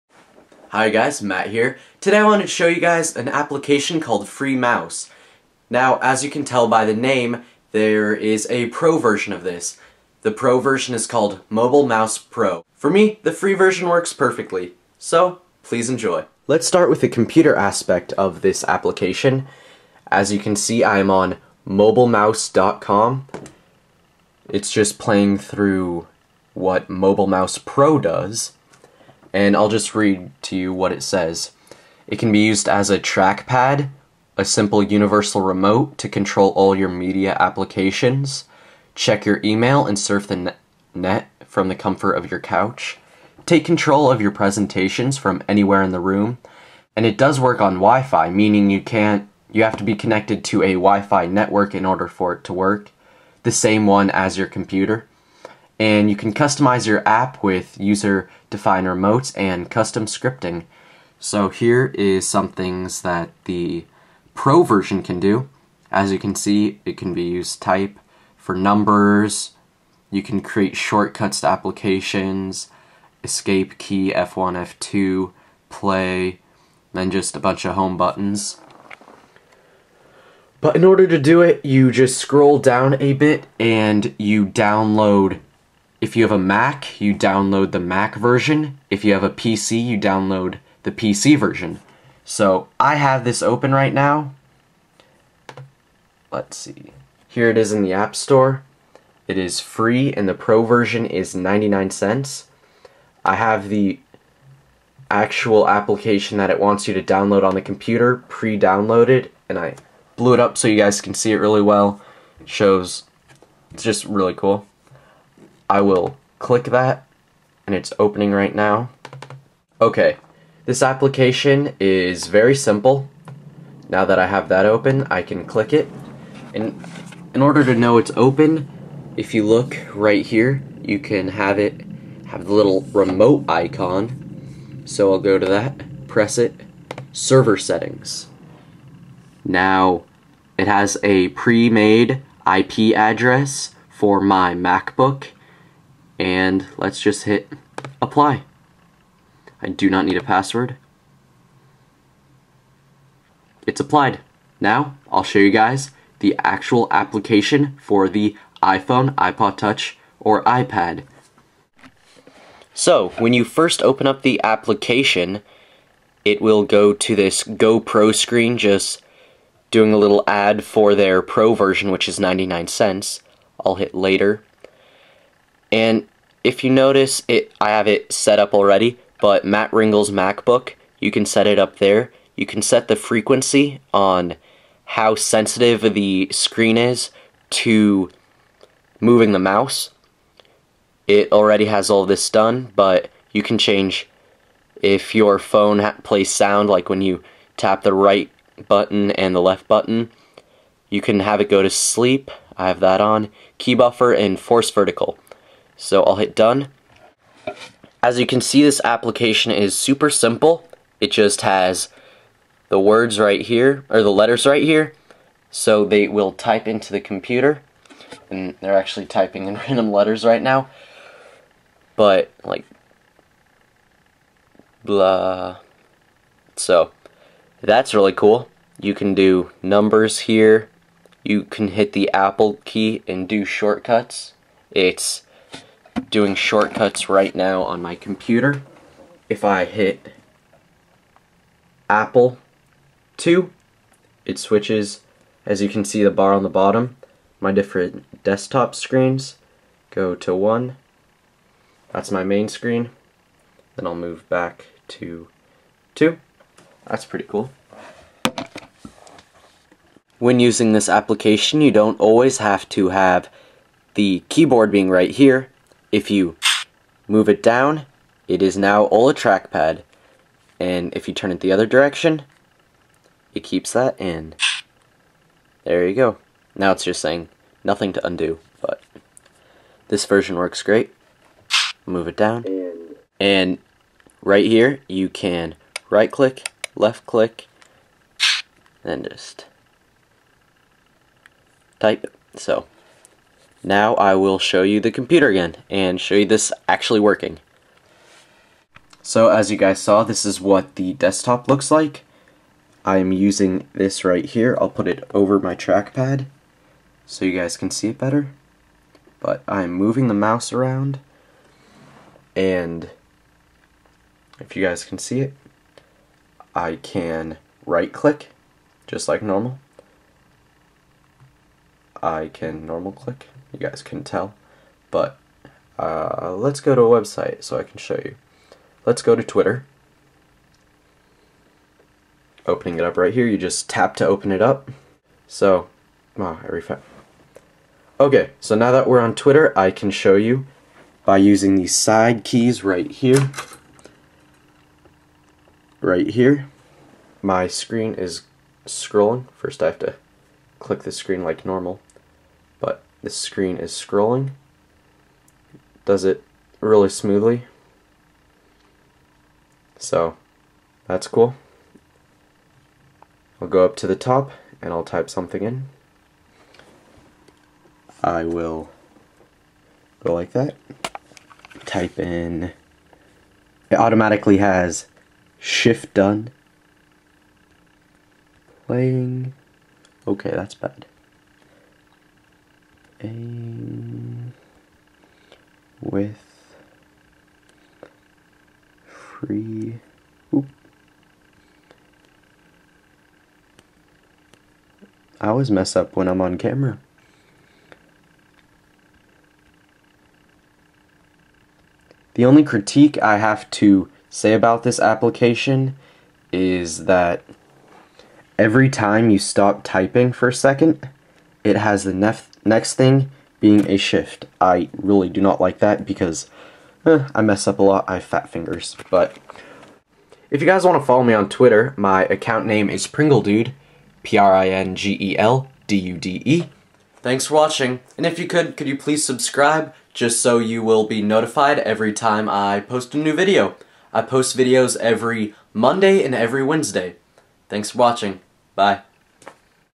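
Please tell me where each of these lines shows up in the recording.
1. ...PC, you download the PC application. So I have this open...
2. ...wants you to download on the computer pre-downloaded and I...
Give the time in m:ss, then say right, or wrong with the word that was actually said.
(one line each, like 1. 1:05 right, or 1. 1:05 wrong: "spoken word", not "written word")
1. 1:29 wrong: "version", not "application"
2. 1:46 right.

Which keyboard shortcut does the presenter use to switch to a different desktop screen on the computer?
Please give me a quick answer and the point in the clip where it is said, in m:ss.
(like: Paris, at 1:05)
Apple 2, at 4:01.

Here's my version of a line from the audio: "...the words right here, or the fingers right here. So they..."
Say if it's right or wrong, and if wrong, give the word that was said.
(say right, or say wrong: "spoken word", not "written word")
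wrong: "letters", not "fingers".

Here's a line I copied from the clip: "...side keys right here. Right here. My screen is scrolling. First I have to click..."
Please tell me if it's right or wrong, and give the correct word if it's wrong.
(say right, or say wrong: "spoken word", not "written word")
right.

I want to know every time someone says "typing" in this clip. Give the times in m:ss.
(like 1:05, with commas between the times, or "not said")
3:39, 6:49.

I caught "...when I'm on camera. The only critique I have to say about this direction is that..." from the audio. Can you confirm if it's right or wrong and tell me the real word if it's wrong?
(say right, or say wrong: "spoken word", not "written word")
wrong: "application", not "direction".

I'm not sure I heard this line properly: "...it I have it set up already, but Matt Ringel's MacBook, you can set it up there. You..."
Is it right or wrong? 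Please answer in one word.
right.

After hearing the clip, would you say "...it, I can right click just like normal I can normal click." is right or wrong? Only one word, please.
right.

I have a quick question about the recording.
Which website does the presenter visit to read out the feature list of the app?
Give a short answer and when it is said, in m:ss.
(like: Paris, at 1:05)
mobilemouse.com, at 0:21.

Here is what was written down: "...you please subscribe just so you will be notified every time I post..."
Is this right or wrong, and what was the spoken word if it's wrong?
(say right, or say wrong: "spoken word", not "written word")
right.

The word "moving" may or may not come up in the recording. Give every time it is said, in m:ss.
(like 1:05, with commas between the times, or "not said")
3:08, 5:09.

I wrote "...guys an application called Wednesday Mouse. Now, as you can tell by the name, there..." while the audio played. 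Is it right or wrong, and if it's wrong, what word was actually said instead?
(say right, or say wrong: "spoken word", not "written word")
wrong: "Free", not "Wednesday".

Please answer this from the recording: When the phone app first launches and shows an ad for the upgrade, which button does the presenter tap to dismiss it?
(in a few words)
later.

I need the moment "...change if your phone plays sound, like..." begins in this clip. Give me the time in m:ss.
3:13.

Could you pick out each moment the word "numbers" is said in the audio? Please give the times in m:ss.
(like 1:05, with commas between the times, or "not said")
1:08, 3:49.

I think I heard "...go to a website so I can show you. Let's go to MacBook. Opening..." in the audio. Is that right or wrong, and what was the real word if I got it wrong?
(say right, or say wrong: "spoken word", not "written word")
wrong: "Twitter", not "MacBook".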